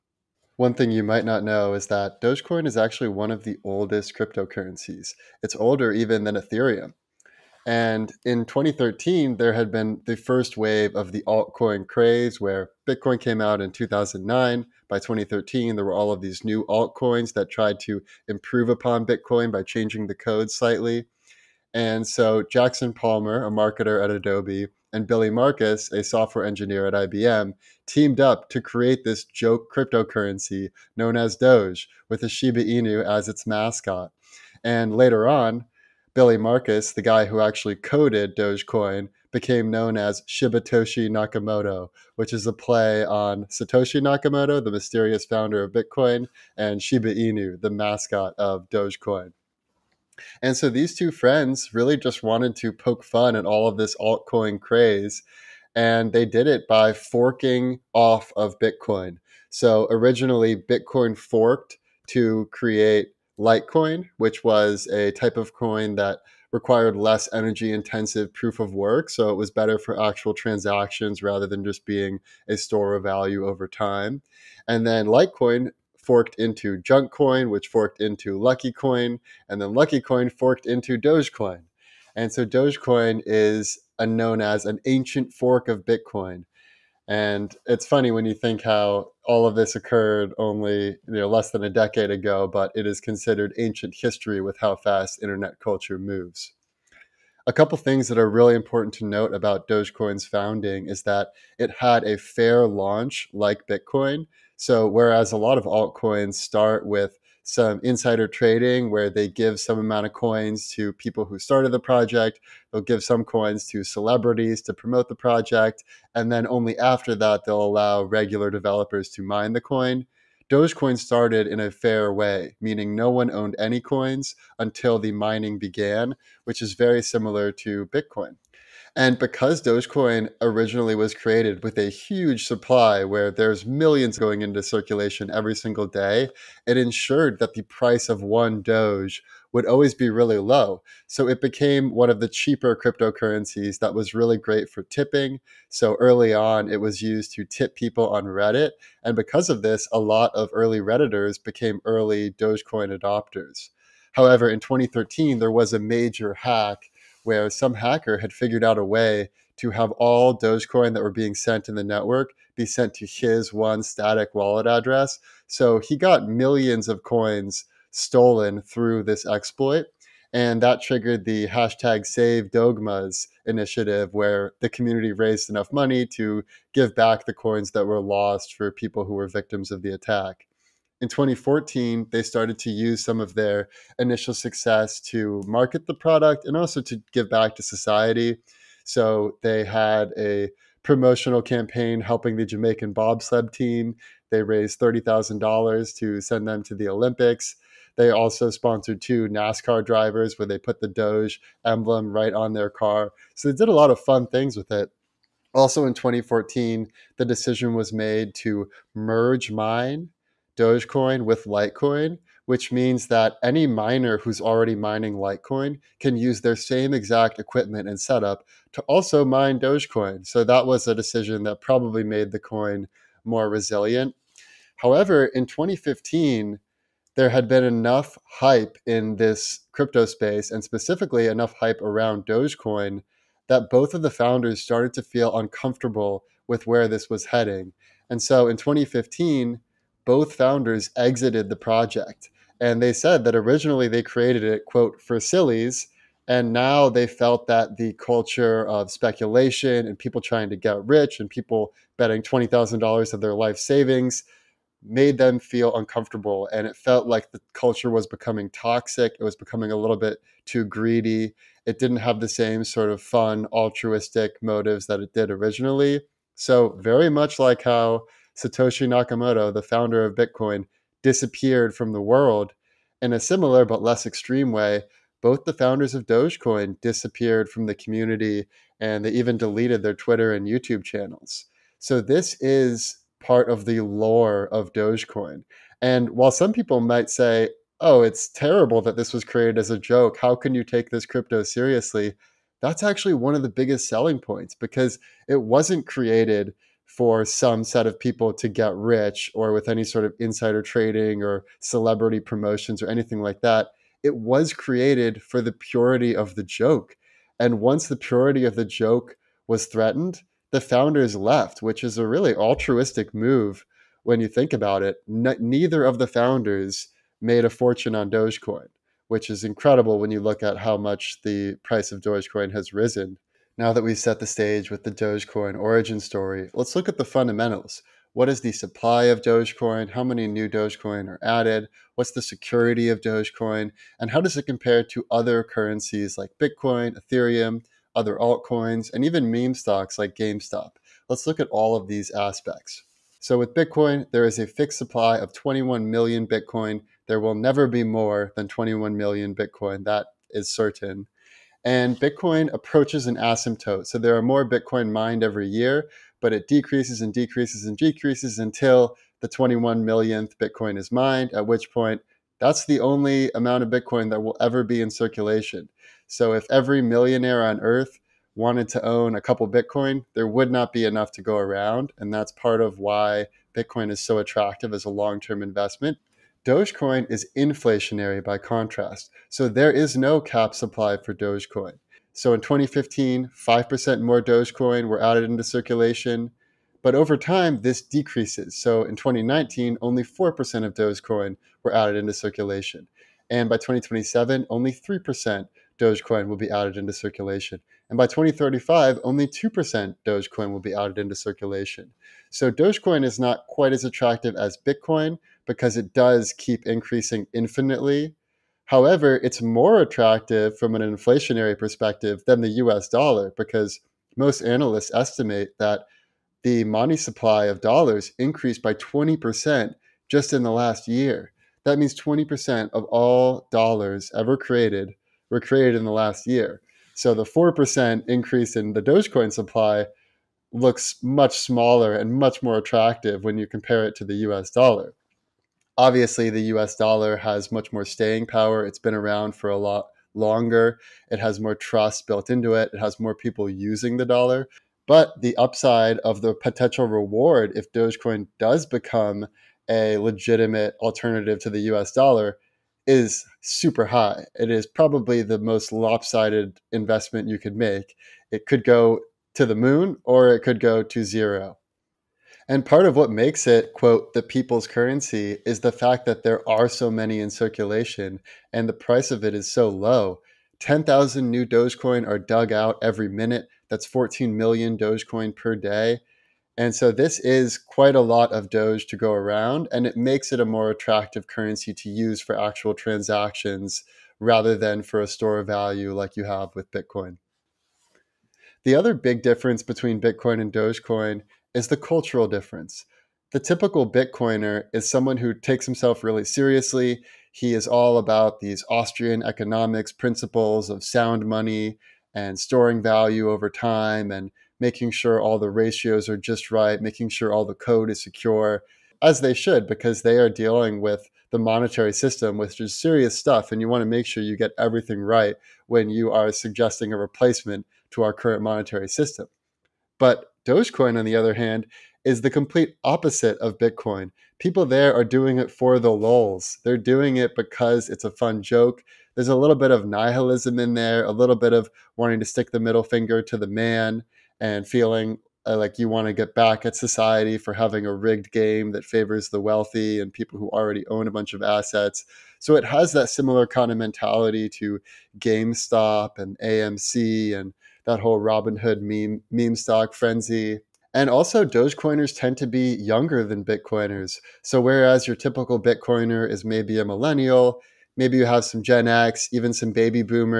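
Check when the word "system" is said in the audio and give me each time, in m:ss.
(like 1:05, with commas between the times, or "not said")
8:31, 8:38.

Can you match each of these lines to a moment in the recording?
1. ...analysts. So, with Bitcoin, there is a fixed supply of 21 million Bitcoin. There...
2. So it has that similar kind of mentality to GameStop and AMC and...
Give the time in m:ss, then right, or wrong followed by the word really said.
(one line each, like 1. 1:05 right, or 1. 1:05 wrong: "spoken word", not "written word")
1. 5:42 wrong: "aspects", not "analysts"
2. 9:02 right.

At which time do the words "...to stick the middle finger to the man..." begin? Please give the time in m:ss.
8:52.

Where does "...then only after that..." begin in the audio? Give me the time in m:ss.
1:56.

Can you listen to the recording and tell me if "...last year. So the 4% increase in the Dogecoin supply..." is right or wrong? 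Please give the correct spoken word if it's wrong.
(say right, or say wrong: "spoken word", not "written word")
right.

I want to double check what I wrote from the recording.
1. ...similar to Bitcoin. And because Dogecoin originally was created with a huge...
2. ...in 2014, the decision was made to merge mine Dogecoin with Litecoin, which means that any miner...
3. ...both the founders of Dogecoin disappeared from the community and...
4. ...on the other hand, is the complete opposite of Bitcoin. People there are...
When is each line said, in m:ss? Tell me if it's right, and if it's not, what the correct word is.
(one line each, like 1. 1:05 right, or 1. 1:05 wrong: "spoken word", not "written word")
1. 2:07 right
2. 3:25 right
3. 4:35 right
4. 8:40 right.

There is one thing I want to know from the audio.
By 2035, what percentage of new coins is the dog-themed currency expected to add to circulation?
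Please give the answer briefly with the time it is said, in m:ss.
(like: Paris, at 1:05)
2%, at 6:39.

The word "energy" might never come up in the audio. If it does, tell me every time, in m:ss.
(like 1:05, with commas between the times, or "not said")
1:07.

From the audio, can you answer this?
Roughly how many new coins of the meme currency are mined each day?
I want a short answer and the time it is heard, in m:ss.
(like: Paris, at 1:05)
14 million, at 7:53.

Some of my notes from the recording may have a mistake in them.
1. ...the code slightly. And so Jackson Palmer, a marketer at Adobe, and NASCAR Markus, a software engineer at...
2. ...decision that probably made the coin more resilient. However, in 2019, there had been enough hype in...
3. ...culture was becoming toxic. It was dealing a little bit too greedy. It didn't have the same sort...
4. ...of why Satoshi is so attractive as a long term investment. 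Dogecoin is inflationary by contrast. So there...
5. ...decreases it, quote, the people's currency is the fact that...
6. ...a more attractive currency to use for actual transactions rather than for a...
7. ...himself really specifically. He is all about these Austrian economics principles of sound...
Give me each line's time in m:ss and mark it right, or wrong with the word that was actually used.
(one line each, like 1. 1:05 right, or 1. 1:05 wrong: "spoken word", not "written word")
1. 0:20 wrong: "Billy", not "NASCAR"
2. 3:40 wrong: "2015", not "2019"
3. 4:17 wrong: "becoming", not "dealing"
4. 6:12 wrong: "Bitcoin", not "Satoshi"
5. 7:43 wrong: "makes", not "decreases"
6. 8:00 right
7. 8:15 wrong: "seriously", not "specifically".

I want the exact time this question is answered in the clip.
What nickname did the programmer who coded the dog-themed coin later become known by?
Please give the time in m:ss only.
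0:40.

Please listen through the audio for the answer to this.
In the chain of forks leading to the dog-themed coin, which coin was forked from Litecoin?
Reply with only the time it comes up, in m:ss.
1:16.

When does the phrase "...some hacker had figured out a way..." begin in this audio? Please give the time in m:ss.
2:37.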